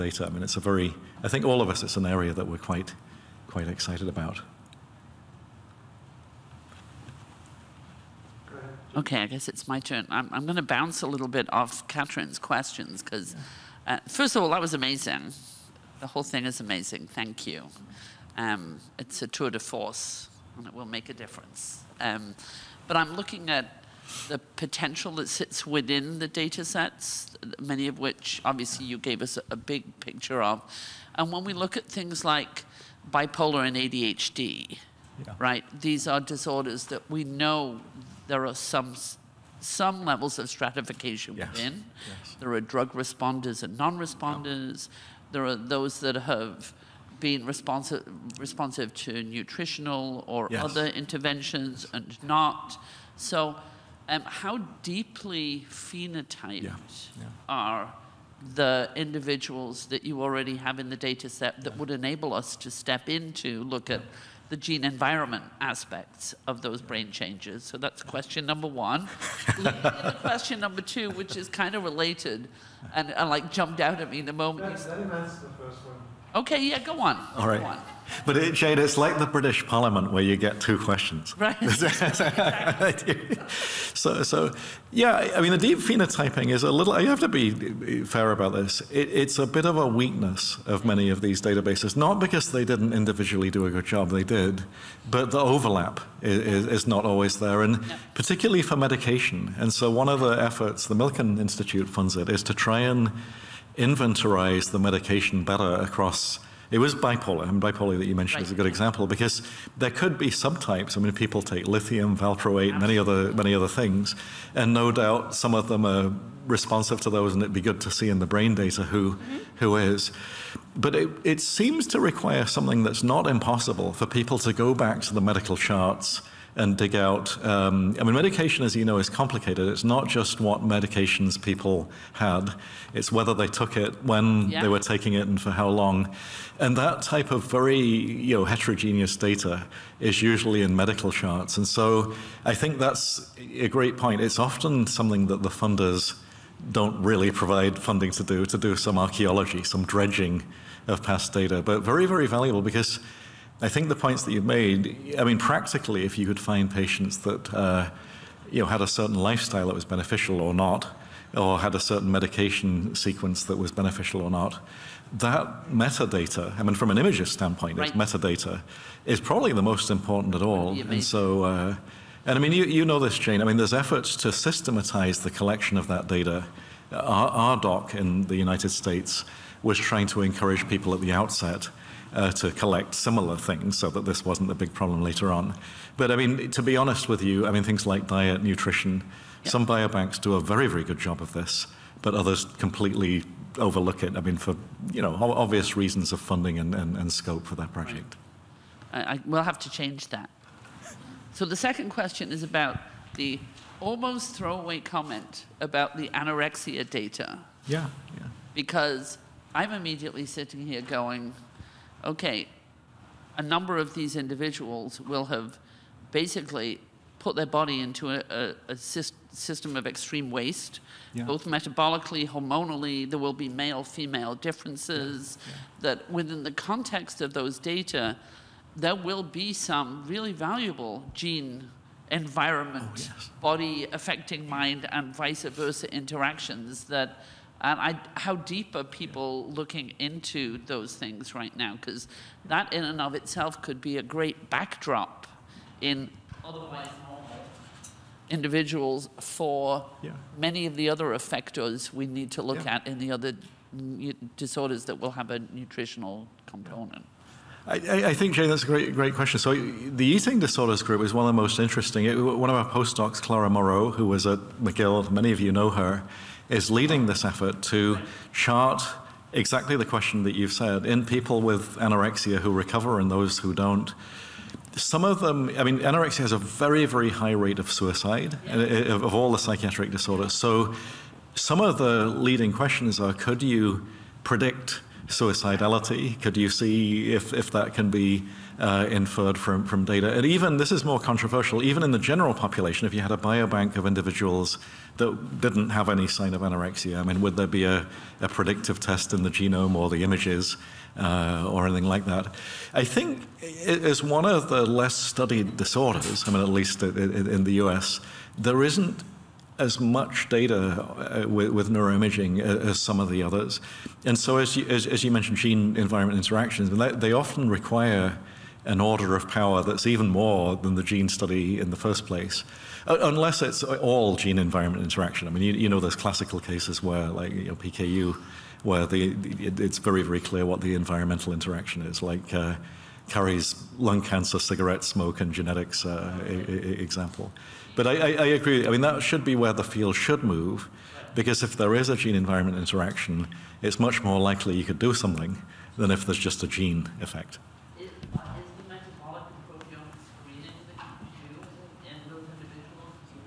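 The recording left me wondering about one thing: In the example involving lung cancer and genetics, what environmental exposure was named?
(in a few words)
cigarette smoke.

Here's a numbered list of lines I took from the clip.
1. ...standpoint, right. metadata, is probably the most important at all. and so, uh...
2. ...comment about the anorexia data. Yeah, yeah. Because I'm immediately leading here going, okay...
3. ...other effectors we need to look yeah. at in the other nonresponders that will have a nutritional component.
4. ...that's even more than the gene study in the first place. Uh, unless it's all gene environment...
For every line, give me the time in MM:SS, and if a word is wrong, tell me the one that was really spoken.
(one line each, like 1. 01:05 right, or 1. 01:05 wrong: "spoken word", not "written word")
1. 02:47 right
2. 03:24 wrong: "sitting", not "leading"
3. 04:10 wrong: "disorders", not "nonresponders"
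4. 05:19 right.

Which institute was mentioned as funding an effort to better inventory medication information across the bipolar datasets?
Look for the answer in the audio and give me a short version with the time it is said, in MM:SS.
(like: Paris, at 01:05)
Milken Institute, at 01:40.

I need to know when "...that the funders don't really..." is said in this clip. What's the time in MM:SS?
02:25.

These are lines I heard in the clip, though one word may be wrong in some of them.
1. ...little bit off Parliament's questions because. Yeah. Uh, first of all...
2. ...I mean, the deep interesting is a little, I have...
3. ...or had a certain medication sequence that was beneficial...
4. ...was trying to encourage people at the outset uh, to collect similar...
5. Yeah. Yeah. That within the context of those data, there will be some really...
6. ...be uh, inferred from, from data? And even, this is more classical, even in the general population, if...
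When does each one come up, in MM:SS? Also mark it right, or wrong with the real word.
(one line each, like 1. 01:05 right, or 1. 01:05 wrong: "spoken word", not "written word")
1. 00:11 wrong: "Catherine", not "Parliament"
2. 01:25 wrong: "phenotyping", not "interesting"
3. 02:41 right
4. 02:59 right
5. 03:45 right
6. 04:47 wrong: "controversial", not "classical".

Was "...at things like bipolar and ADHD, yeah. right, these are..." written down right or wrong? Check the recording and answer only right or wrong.
right.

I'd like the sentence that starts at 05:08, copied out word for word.
There isn't as much data uh, with, with, neuroimaging uh, as, some of the others.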